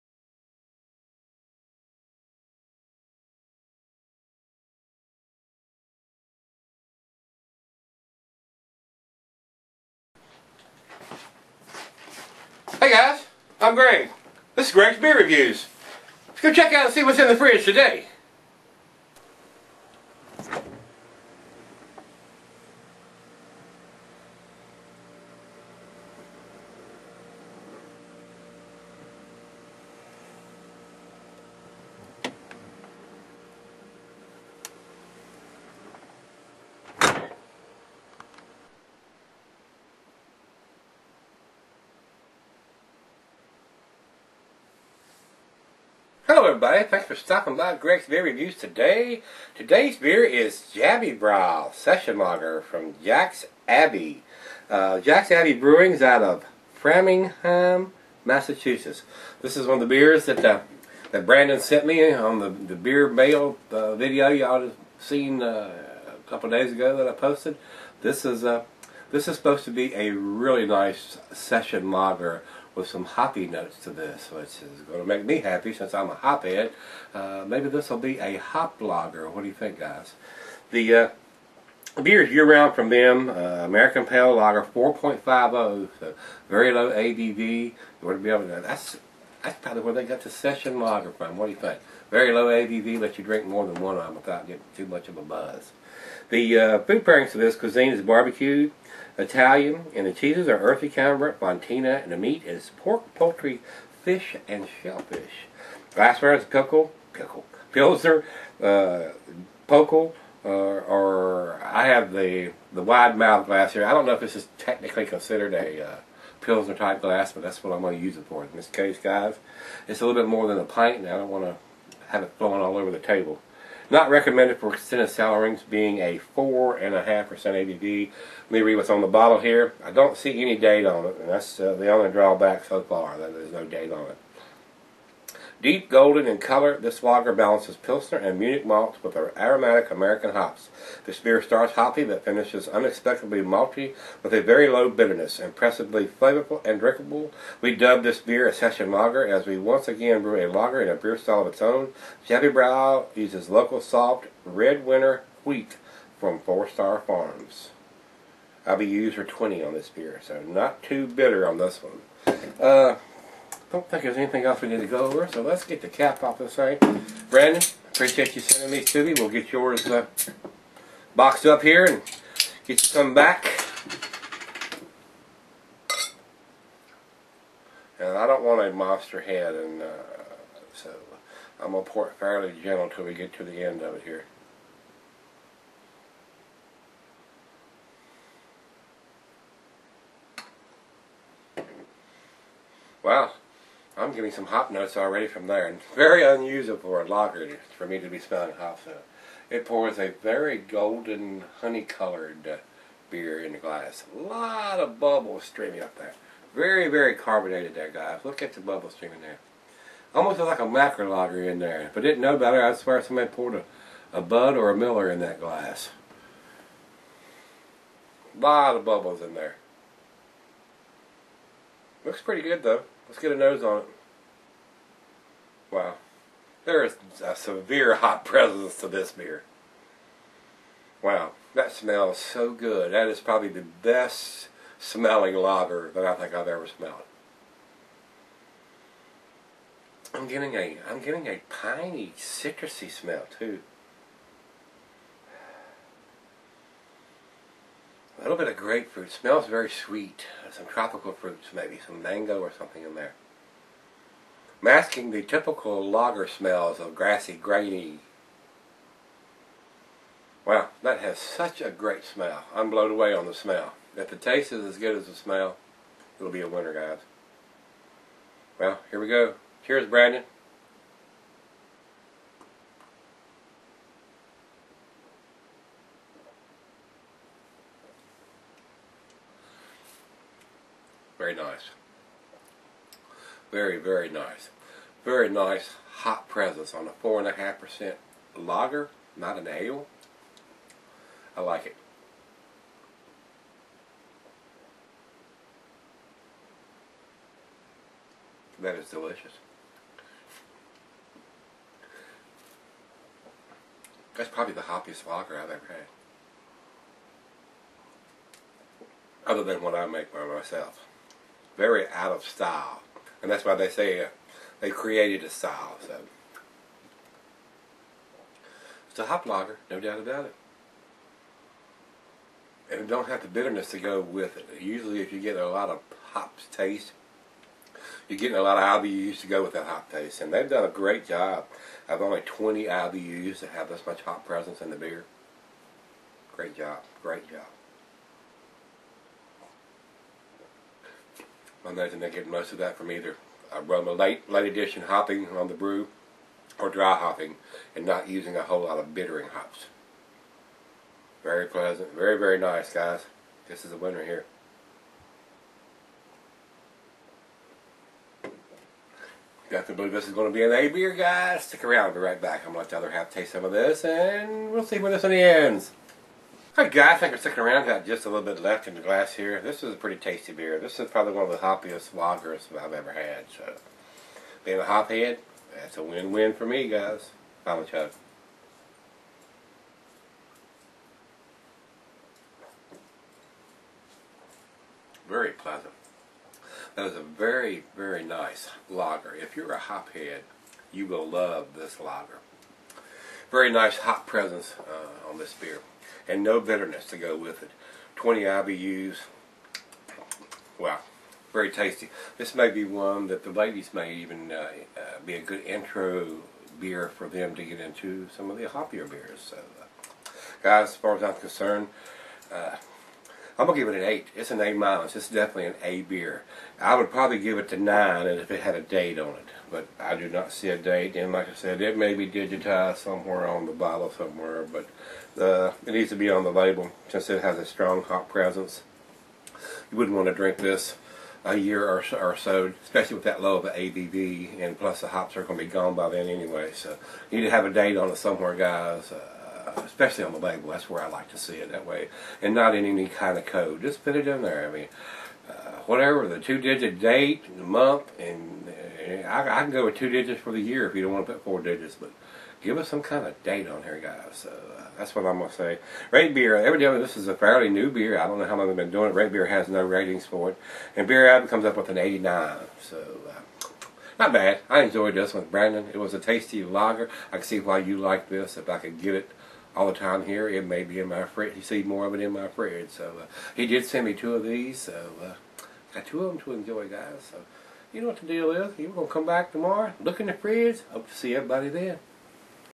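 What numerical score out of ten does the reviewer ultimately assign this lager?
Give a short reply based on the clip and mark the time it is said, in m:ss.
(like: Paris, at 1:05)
8, at 6:53.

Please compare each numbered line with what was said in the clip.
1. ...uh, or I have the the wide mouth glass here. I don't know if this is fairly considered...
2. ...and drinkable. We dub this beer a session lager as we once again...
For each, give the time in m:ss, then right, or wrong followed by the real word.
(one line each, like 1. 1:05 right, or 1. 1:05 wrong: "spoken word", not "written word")
1. 1:50 wrong: "technically", not "fairly"
2. 2:26 right.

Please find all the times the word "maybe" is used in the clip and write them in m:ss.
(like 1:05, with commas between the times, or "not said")
1:17, 4:11.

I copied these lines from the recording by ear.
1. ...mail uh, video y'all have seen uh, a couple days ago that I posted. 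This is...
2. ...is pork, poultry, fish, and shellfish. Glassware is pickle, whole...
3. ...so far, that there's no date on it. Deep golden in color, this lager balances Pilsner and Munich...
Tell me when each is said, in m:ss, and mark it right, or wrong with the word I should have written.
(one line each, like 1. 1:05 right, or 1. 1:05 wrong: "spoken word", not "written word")
1. 1:03 right
2. 1:42 wrong: "pickle", not "whole"
3. 2:12 right.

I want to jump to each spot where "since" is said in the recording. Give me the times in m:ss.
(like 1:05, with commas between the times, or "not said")
1:15, 7:06.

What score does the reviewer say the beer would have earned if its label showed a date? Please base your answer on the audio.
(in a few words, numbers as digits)
9.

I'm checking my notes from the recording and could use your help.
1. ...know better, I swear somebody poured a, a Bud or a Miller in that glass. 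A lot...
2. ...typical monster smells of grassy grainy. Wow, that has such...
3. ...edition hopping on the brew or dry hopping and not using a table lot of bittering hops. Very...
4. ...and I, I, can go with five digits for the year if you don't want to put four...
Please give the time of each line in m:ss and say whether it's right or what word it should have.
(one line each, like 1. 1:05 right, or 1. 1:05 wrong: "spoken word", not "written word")
1. 3:32 right
2. 4:15 wrong: "lager", not "monster"
3. 5:44 wrong: "whole", not "table"
4. 7:27 wrong: "two", not "five".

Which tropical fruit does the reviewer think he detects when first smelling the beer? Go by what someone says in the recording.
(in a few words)
Mango.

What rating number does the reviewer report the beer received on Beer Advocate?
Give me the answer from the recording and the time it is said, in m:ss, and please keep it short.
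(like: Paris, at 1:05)
89, at 7:41.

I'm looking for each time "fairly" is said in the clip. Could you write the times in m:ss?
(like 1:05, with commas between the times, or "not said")
3:02, 7:37.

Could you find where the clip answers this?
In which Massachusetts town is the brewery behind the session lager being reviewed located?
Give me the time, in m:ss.
0:56.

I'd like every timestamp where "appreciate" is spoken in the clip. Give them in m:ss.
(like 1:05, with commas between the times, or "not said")
2:47.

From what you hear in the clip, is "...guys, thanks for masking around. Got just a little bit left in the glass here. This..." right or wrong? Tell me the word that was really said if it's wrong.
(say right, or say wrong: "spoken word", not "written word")
wrong: "sticking", not "masking".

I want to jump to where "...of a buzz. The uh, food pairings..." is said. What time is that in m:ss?
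1:35.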